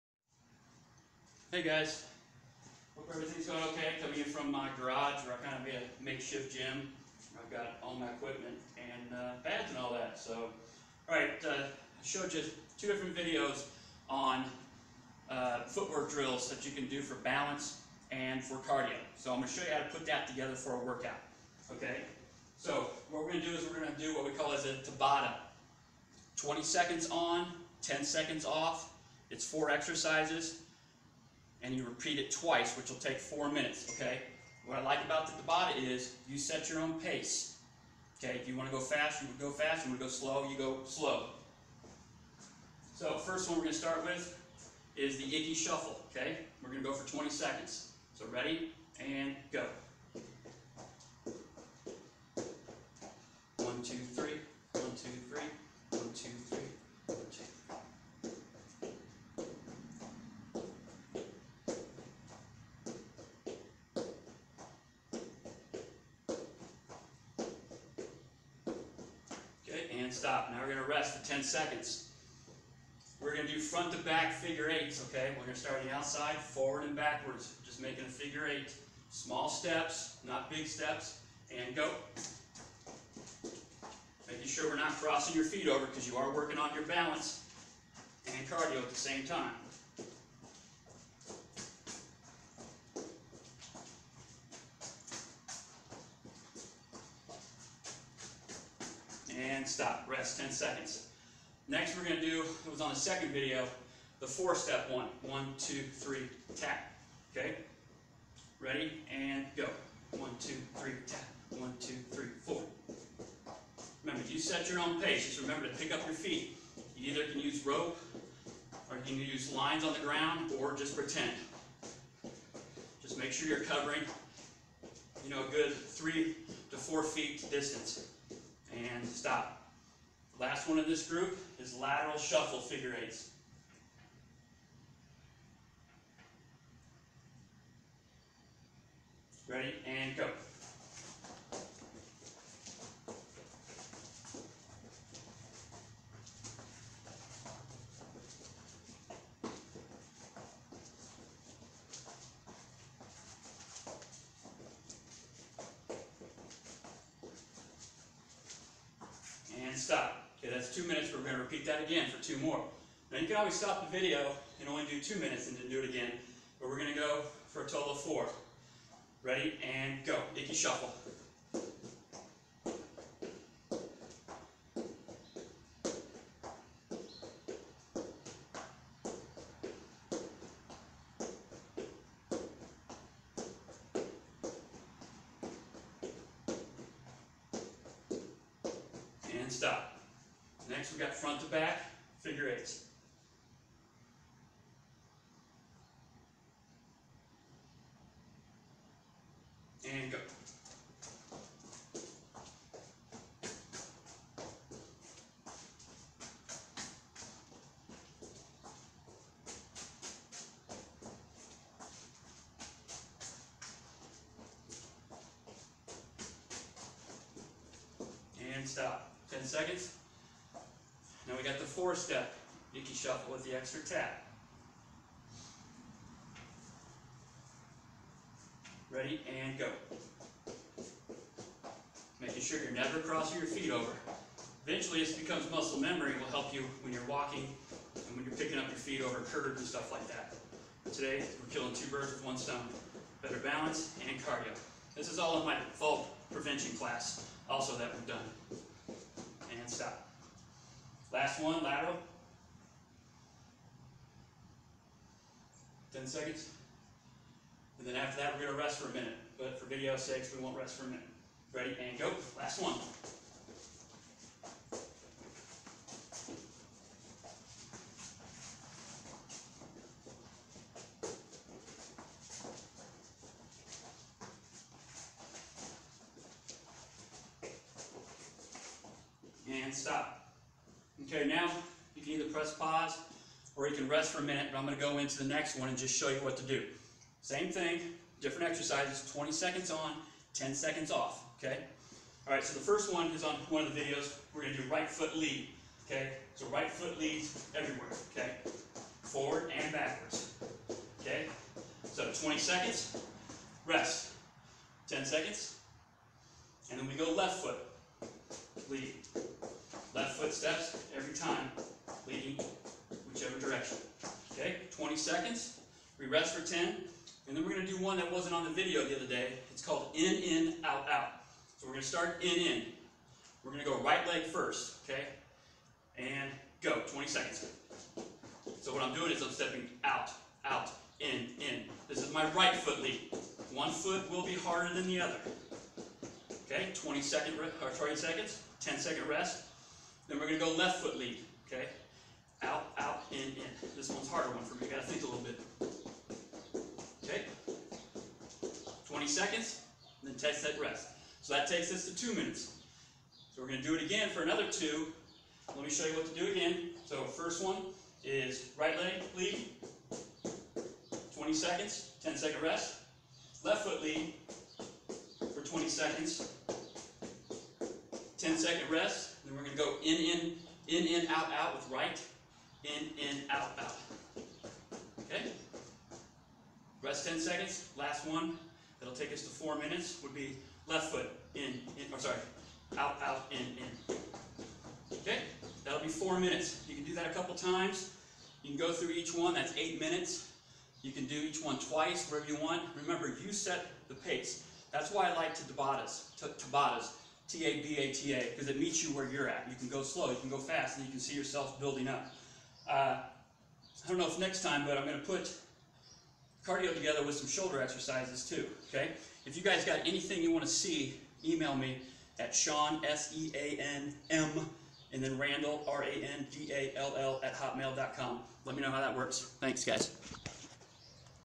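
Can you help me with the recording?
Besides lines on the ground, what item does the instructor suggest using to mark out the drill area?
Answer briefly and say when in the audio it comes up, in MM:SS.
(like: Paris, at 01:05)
Rope, at 01:57.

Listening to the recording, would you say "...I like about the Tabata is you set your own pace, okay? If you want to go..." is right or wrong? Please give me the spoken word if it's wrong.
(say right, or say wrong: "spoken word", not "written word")
right.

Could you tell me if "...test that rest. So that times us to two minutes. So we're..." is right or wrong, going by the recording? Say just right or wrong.
wrong.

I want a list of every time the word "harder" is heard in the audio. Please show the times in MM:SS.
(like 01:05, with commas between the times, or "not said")
05:34, 05:44.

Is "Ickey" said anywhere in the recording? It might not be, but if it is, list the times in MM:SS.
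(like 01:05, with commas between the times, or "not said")
00:45, 02:50.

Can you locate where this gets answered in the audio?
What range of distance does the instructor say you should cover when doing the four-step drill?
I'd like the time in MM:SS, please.
02:05.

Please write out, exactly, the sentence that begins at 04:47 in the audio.
Same thing, different exercises, 20 seconds on, 10 seconds off, okay?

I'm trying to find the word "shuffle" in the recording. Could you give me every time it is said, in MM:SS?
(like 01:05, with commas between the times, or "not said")
00:45, 02:12, 02:50, 03:42.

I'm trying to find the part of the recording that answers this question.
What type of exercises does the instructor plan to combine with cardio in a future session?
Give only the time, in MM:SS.
06:47.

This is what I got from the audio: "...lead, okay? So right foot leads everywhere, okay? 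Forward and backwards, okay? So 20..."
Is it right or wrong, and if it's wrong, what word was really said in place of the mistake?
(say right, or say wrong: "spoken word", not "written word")
right.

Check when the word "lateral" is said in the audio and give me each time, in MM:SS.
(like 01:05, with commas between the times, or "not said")
02:11, 04:11.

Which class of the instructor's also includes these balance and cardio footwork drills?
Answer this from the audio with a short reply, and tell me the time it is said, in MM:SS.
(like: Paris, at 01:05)
Fall prevention class, at 04:05.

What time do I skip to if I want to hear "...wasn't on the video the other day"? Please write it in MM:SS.
05:18.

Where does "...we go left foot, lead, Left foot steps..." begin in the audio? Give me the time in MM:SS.
05:06.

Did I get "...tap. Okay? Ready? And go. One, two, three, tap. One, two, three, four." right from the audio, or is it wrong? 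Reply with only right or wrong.
right.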